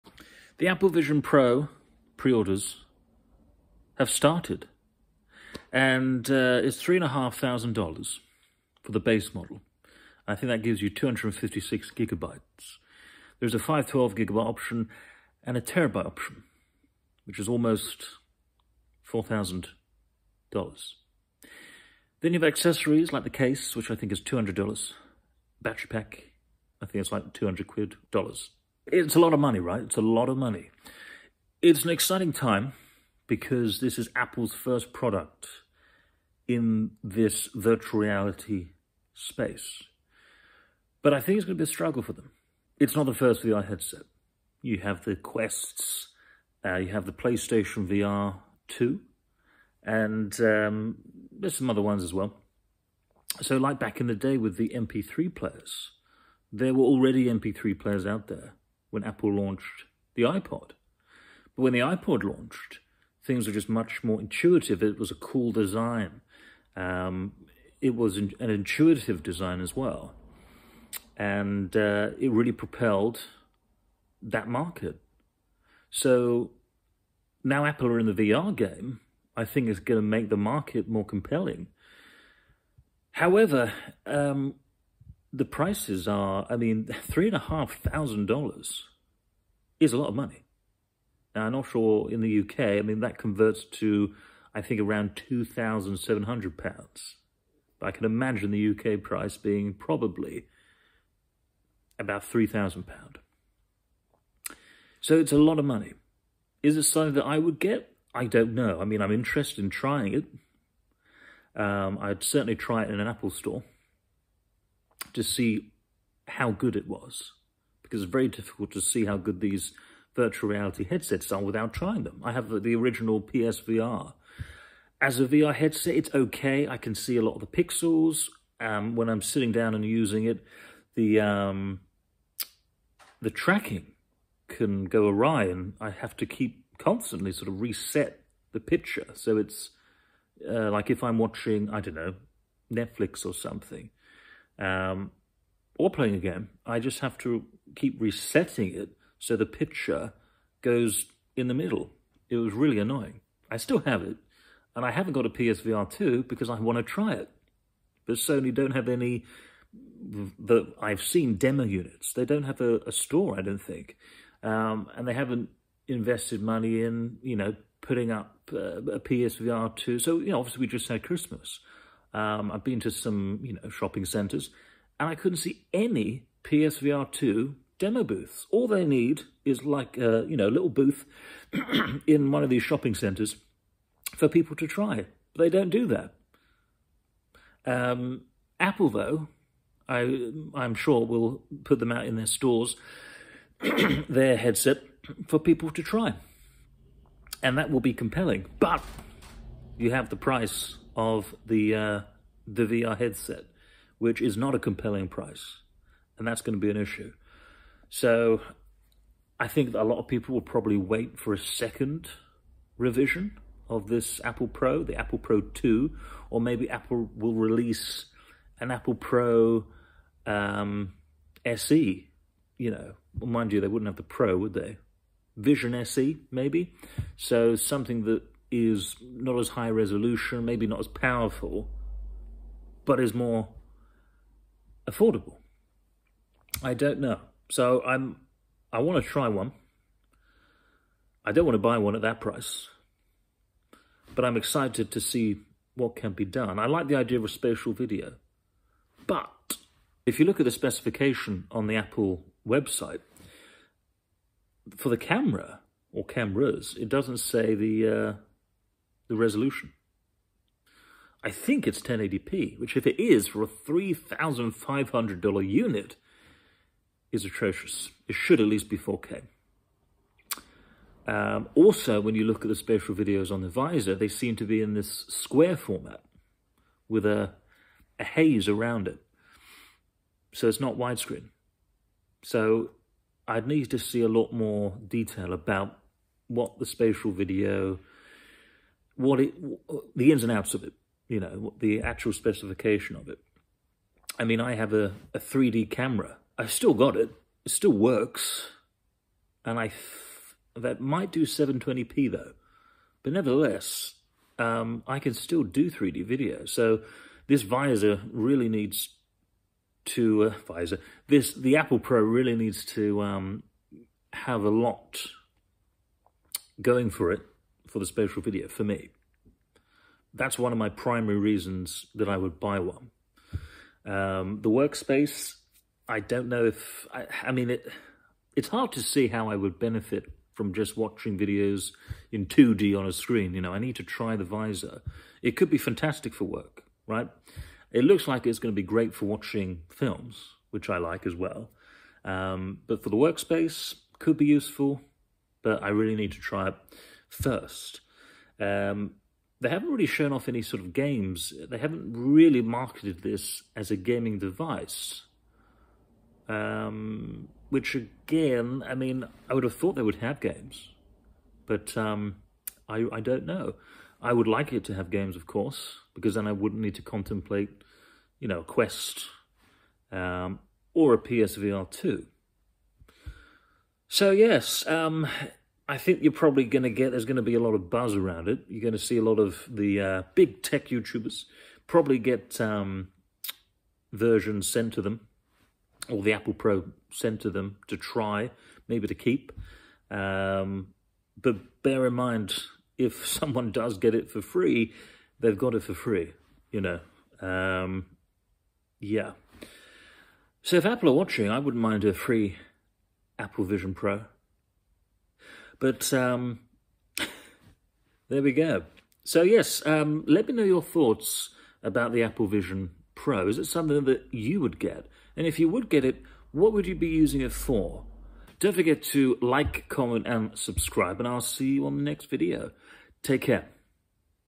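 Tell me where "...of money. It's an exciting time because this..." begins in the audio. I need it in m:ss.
0:30.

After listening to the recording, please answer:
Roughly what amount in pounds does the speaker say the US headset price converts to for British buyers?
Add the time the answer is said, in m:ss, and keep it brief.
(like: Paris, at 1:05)
£2,700, at 1:35.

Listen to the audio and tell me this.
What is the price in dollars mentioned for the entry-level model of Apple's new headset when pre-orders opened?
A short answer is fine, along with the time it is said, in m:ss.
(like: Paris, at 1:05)
$3,500, at 0:06.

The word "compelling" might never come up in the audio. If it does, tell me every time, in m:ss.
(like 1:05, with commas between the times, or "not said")
1:21, 3:17, 3:24.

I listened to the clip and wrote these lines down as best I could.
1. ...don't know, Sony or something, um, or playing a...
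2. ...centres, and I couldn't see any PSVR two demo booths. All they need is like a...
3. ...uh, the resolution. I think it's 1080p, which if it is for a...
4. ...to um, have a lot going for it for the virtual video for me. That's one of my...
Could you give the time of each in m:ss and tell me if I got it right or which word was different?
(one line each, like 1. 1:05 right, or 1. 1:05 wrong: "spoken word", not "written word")
1. 2:21 wrong: "Netflix", not "Sony"
2. 2:54 right
3. 4:18 right
4. 5:12 wrong: "spatial", not "virtual".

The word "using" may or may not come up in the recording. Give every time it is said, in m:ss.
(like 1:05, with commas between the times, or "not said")
2:09, 6:56.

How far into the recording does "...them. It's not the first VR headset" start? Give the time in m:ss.
0:42.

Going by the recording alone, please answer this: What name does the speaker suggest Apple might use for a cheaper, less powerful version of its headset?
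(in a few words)
Vision SE.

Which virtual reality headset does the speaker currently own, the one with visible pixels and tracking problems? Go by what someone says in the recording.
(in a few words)
original PSVR.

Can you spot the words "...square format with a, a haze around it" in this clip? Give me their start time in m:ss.
4:35.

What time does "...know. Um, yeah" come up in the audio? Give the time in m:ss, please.
6:36.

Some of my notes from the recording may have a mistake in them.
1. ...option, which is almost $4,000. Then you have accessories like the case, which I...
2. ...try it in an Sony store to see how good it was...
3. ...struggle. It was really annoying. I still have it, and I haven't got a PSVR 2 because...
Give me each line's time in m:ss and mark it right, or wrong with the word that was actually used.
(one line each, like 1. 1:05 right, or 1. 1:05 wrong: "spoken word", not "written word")
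1. 0:16 right
2. 1:52 wrong: "Apple", not "Sony"
3. 2:31 wrong: "middle", not "struggle".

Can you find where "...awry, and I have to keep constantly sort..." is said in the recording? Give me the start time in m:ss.
2:15.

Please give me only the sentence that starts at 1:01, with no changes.
But when the iPod launched, things were just much more intuitive.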